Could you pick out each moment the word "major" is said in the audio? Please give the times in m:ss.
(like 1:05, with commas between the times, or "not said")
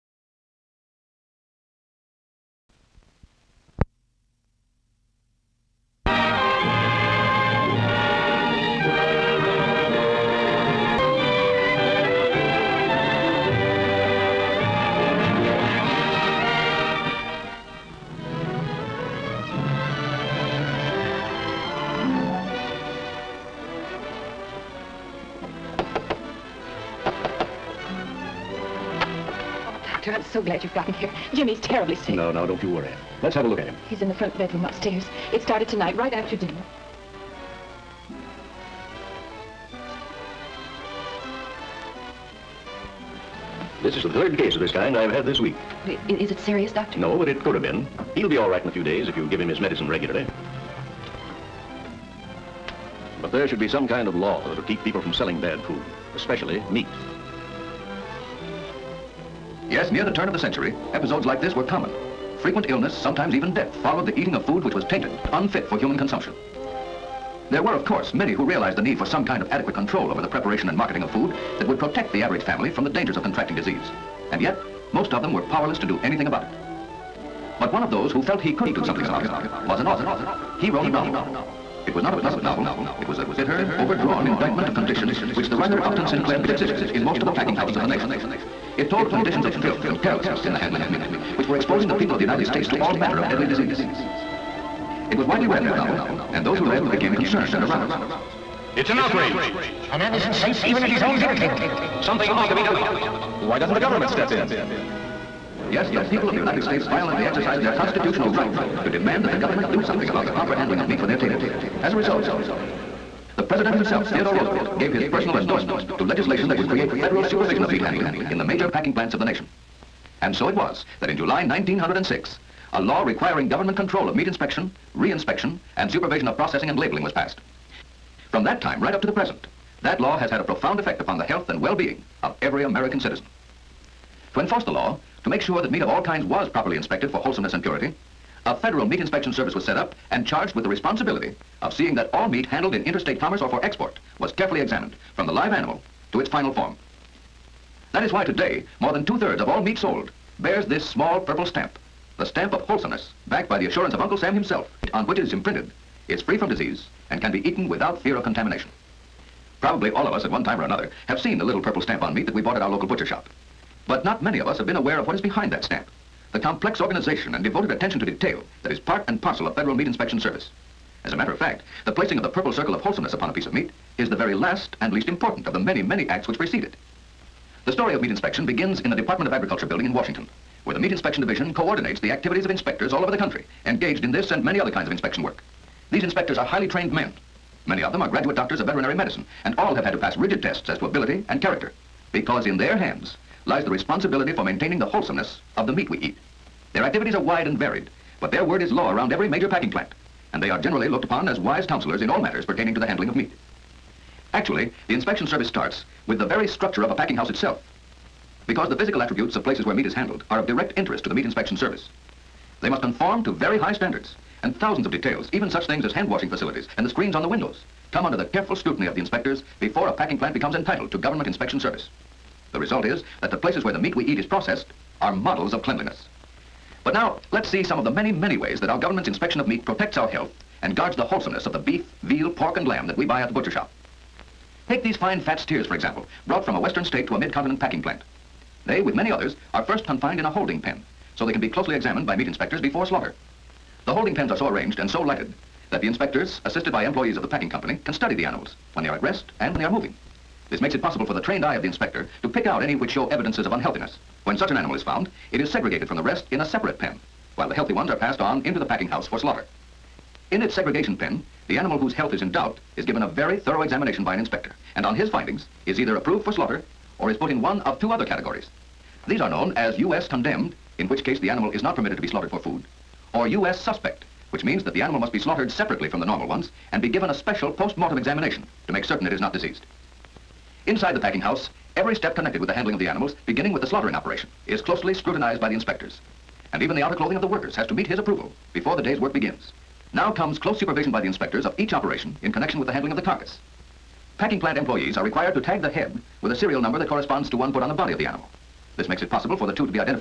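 1:58, 3:19.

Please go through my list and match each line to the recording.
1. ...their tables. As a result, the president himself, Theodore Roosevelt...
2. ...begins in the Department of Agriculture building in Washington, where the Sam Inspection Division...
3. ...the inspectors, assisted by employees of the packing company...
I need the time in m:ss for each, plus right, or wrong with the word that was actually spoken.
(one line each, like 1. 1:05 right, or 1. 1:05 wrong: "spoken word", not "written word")
1. 1:51 right
2. 2:58 wrong: "Meat", not "Sam"
3. 4:05 right.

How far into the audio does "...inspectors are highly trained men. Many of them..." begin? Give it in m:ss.
3:06.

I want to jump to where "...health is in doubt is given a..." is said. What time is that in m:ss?
4:21.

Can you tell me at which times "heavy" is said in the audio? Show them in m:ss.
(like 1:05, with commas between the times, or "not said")
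not said.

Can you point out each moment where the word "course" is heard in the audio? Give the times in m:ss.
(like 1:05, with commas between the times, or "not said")
1:07.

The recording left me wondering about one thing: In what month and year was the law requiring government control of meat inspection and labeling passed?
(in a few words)
July 1906.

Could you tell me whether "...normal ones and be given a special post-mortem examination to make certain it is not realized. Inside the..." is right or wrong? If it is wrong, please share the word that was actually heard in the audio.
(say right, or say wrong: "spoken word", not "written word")
wrong: "diseased", not "realized".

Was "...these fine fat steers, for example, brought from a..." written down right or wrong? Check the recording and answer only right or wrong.
right.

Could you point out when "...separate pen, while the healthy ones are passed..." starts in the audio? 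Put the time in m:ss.
4:16.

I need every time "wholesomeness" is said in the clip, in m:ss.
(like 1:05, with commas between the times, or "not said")
2:17, 2:32, 2:52, 3:14, 3:51.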